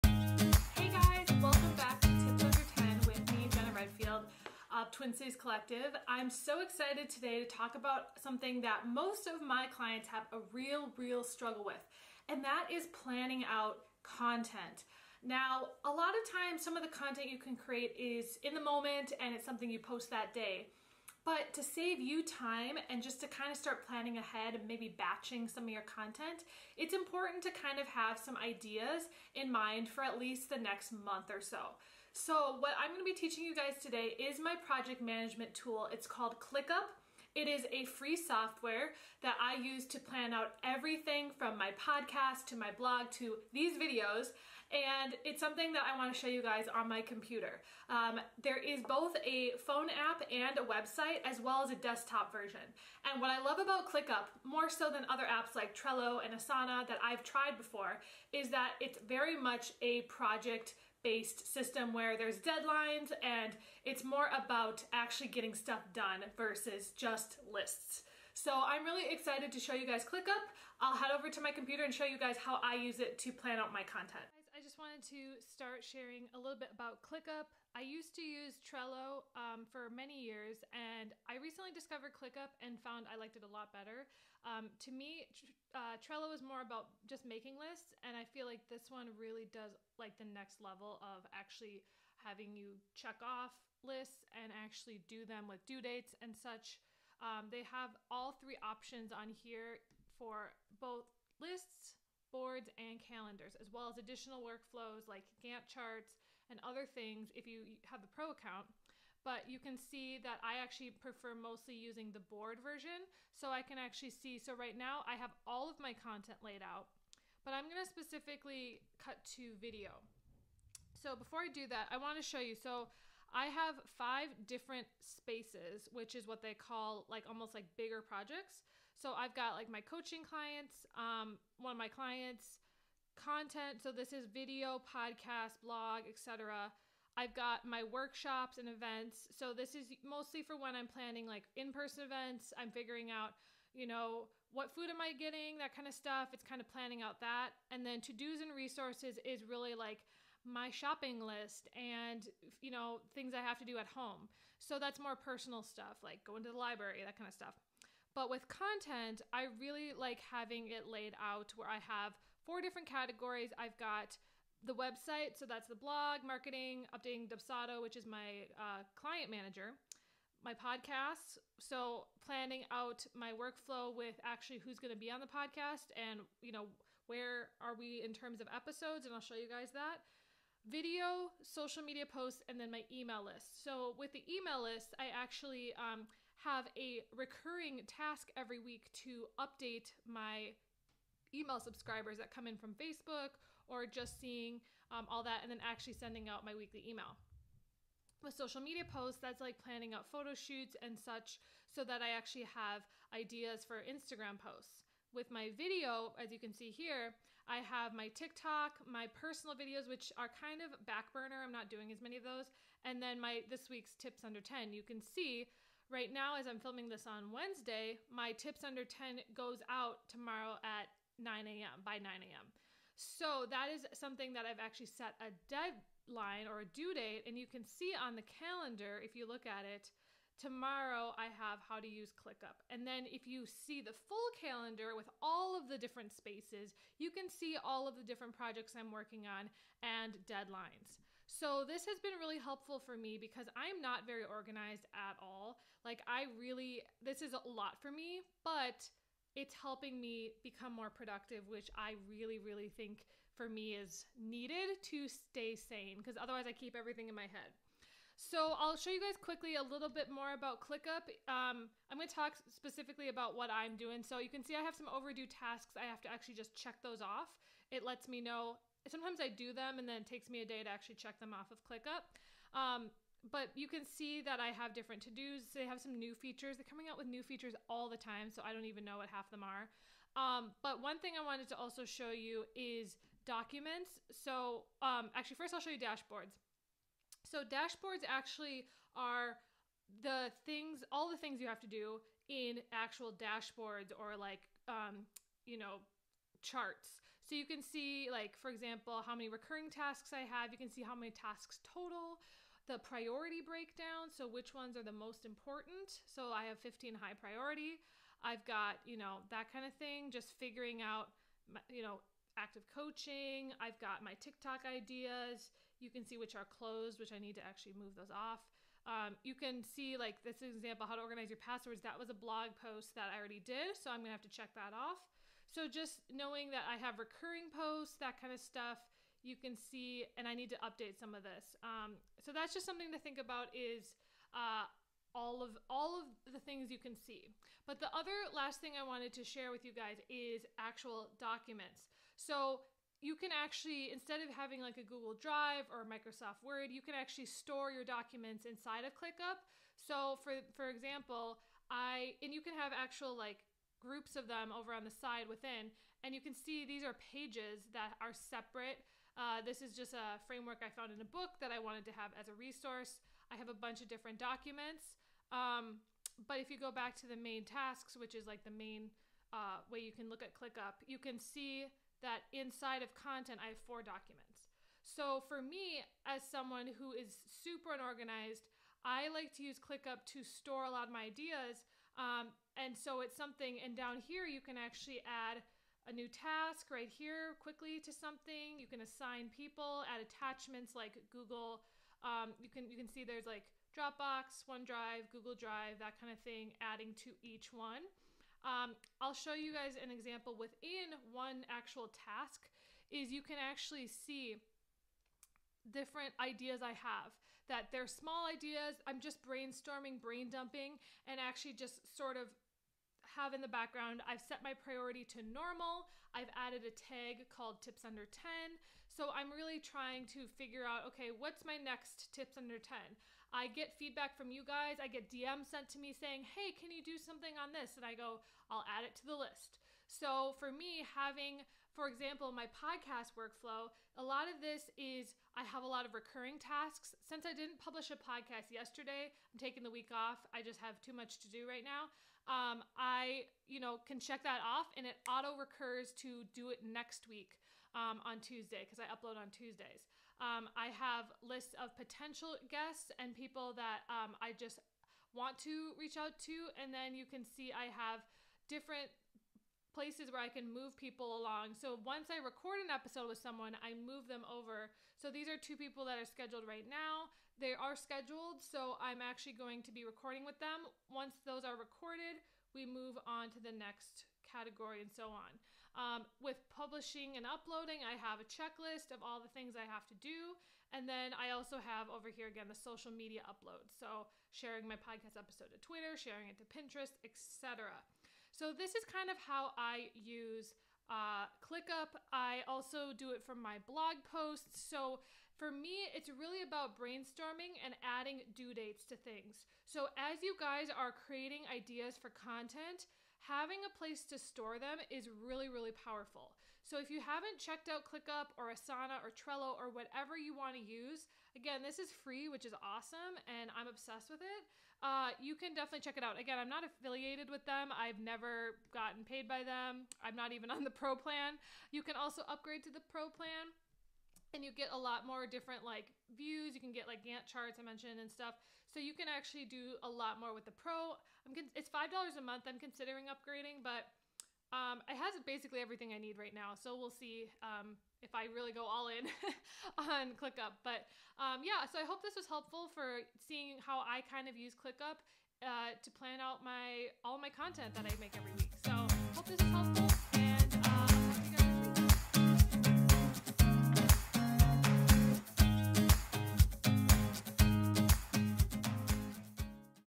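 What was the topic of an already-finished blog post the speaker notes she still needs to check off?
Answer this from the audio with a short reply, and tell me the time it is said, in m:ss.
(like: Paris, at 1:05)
how to organize your passwords, at 5:20.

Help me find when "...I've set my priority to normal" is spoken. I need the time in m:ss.
6:54.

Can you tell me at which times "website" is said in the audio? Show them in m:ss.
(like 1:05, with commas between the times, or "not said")
0:50, 2:44.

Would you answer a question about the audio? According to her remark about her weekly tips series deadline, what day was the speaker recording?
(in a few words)
Wednesday.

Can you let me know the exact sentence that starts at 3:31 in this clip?
I'm not doing as many of those.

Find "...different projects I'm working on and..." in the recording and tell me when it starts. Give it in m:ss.
3:58.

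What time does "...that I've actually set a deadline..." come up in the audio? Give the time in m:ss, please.
3:44.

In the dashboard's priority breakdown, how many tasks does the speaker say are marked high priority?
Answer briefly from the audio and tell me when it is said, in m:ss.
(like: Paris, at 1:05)
15, at 5:06.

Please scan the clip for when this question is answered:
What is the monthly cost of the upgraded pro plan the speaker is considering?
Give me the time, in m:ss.
8:51.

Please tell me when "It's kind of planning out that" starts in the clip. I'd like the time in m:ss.
2:26.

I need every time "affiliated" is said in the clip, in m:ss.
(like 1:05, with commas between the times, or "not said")
8:36.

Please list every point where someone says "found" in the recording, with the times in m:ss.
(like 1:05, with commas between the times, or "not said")
1:22, 6:00.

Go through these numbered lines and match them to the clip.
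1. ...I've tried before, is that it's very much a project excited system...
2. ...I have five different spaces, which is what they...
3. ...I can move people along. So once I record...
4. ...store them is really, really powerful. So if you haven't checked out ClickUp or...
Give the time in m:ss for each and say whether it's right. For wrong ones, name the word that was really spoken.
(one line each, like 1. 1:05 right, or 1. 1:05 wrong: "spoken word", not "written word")
1. 0:57 wrong: "based", not "excited"
2. 2:03 right
3. 7:40 right
4. 8:24 right.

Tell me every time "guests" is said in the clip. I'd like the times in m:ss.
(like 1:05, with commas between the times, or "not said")
7:32.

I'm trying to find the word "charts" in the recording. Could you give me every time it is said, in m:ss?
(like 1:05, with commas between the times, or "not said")
1:45, 4:56, 8:47.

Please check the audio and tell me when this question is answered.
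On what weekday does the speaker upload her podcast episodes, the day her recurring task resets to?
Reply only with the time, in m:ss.
7:29.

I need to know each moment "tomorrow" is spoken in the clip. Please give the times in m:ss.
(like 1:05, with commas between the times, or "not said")
3:40, 3:50.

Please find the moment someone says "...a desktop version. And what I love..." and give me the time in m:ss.
0:51.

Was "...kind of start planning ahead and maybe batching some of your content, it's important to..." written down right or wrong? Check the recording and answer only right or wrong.
right.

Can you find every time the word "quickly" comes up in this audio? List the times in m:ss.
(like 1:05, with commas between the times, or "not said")
4:19, 6:27.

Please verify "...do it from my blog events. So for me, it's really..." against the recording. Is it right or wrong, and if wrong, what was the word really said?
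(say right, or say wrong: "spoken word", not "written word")
wrong: "posts", not "events".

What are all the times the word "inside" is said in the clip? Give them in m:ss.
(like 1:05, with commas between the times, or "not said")
5:48, 6:12.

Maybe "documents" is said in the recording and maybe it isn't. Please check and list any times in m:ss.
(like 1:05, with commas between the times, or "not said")
4:43, 5:41, 5:47, 6:04, 6:13.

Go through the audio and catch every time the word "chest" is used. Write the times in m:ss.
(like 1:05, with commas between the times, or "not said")
not said.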